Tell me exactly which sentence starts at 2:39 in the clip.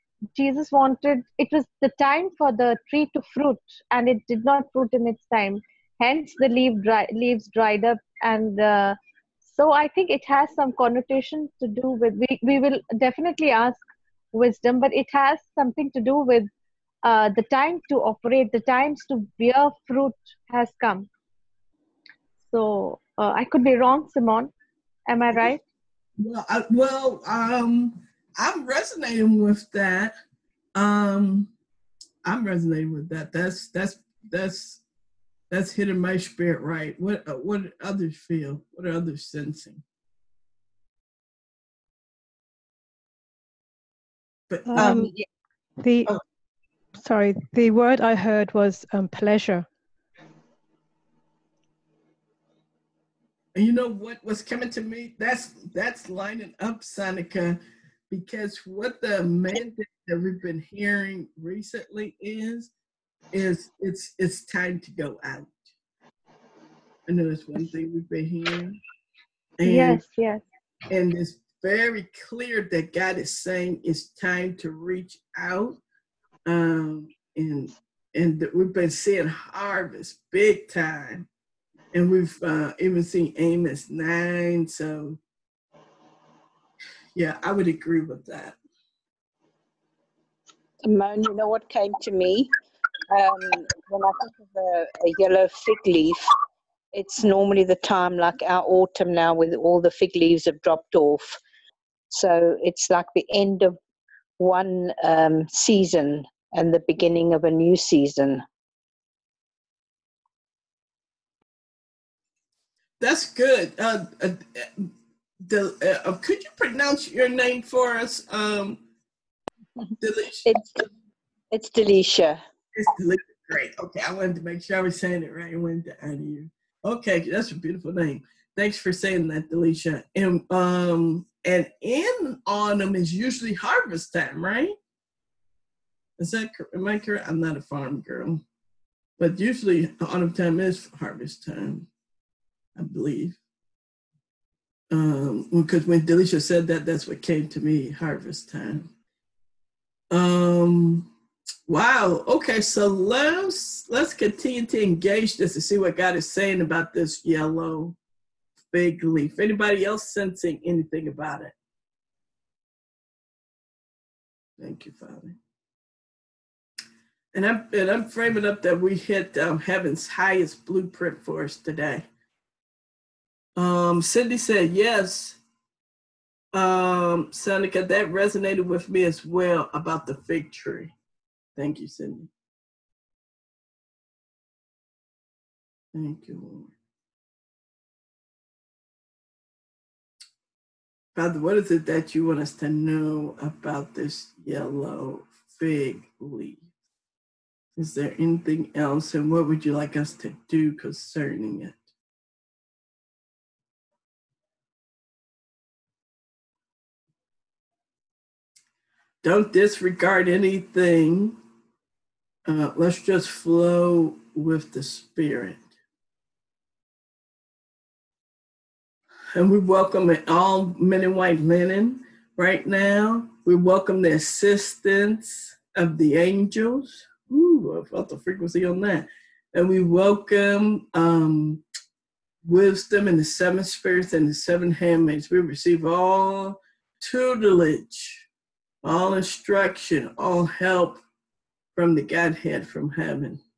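Anybody else sensing anything about it?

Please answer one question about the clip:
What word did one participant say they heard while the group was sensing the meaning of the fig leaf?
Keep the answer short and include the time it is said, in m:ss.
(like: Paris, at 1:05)
pleasure, at 0:49.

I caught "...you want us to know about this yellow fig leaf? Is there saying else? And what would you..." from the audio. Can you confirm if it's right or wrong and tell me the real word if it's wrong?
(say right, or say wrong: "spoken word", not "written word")
wrong: "anything", not "saying".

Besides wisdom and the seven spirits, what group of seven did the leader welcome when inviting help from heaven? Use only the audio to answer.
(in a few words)
seven handmaids.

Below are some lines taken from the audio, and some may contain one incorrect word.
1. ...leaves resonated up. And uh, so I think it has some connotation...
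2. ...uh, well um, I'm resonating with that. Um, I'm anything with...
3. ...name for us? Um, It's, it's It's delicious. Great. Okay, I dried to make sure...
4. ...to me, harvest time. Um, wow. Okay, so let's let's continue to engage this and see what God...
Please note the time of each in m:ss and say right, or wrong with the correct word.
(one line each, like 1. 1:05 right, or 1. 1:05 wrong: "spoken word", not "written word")
1. 0:07 wrong: "dried", not "resonated"
2. 0:26 wrong: "resonating", not "anything"
3. 1:57 wrong: "wanted", not "dried"
4. 2:27 right.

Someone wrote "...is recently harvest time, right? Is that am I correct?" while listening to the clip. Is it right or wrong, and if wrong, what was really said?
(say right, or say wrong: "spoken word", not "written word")
wrong: "usually", not "recently".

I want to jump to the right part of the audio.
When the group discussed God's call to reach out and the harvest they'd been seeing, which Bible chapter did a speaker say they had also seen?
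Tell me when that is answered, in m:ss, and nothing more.
1:23.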